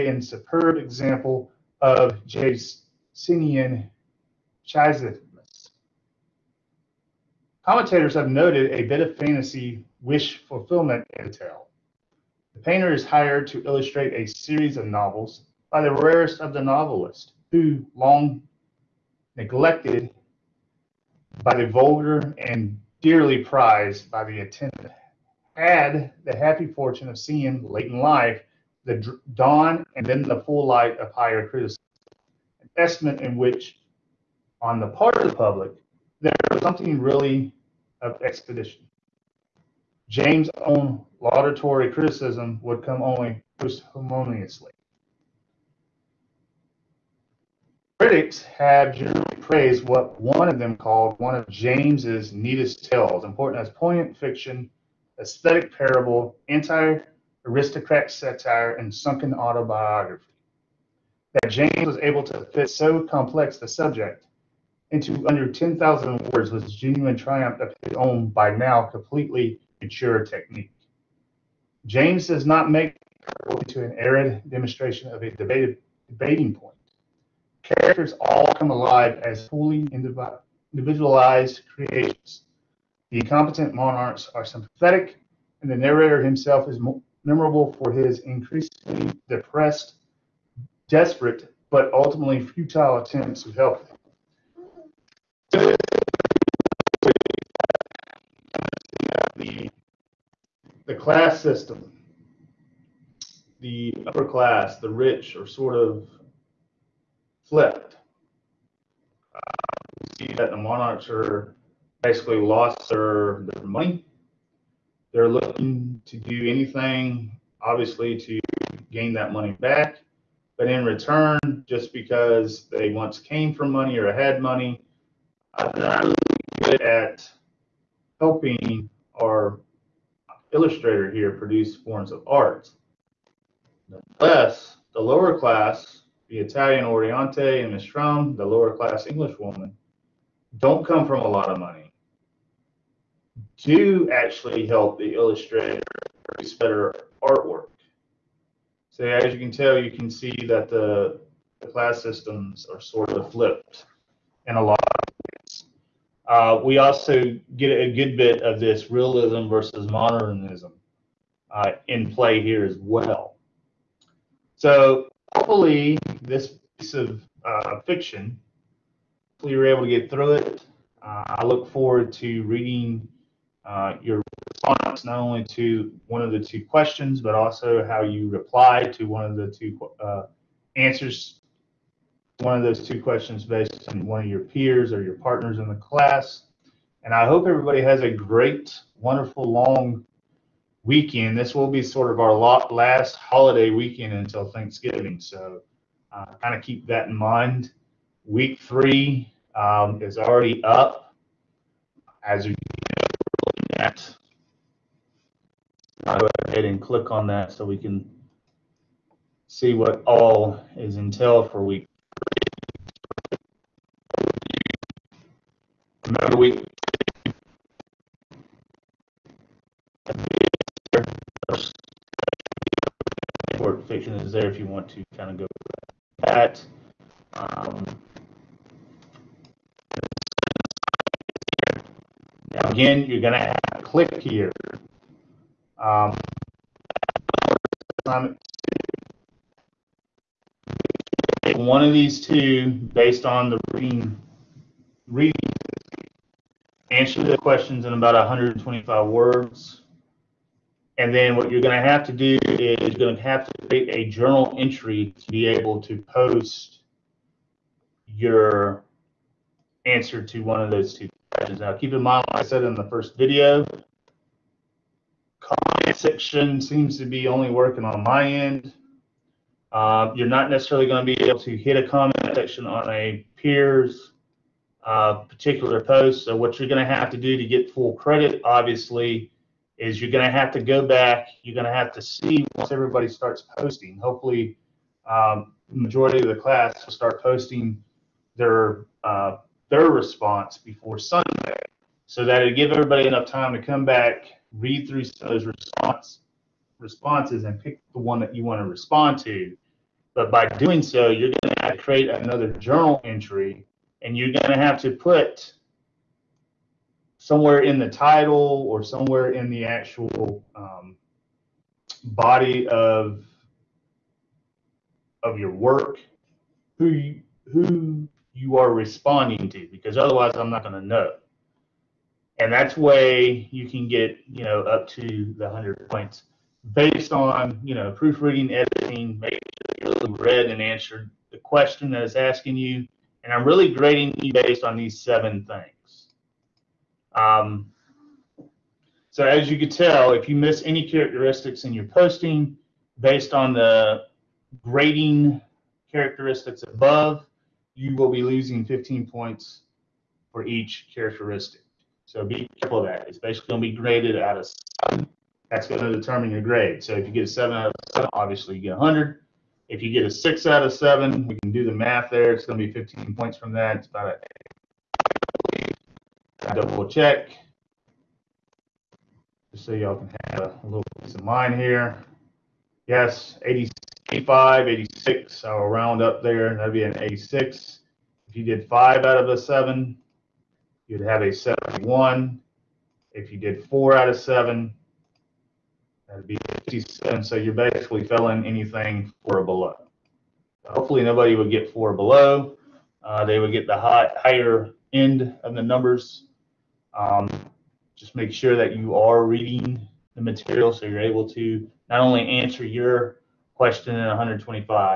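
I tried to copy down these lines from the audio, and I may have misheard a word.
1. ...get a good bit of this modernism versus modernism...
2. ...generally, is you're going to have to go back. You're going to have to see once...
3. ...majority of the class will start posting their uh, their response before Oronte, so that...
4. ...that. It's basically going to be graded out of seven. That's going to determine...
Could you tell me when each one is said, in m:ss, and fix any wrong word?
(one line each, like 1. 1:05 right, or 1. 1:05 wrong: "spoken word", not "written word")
1. 2:37 wrong: "realism", not "modernism"
2. 4:38 wrong: "obviously", not "generally"
3. 4:45 wrong: "Sunday", not "Oronte"
4. 5:52 right.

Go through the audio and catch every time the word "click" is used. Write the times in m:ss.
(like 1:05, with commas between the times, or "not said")
3:26, 3:53.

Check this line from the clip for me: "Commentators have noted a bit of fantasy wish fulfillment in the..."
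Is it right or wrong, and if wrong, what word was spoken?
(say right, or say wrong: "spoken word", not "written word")
right.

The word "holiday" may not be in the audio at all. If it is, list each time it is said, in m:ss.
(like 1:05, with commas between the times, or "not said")
3:13.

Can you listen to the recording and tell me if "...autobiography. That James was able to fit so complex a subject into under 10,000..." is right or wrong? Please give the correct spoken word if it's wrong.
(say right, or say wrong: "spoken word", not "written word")
right.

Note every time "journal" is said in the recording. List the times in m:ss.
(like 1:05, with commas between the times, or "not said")
4:14, 5:02.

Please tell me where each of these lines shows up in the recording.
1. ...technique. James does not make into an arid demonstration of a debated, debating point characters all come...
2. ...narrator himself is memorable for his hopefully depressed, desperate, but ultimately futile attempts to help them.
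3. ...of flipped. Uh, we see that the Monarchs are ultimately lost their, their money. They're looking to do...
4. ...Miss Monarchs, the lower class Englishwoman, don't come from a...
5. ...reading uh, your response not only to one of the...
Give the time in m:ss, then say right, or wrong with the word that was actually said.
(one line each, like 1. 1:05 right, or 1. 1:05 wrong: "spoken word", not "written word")
1. 1:10 right
2. 1:25 wrong: "increasingly", not "hopefully"
3. 1:45 wrong: "basically", not "ultimately"
4. 2:17 wrong: "Churm", not "Monarchs"
5. 2:52 right.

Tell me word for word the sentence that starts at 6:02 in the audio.
It's going to be 15 points from that.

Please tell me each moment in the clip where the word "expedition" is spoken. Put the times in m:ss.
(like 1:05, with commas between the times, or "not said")
0:38.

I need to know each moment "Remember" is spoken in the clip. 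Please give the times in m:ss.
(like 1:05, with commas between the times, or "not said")
3:36.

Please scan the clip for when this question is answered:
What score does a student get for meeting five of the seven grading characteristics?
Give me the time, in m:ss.
6:21.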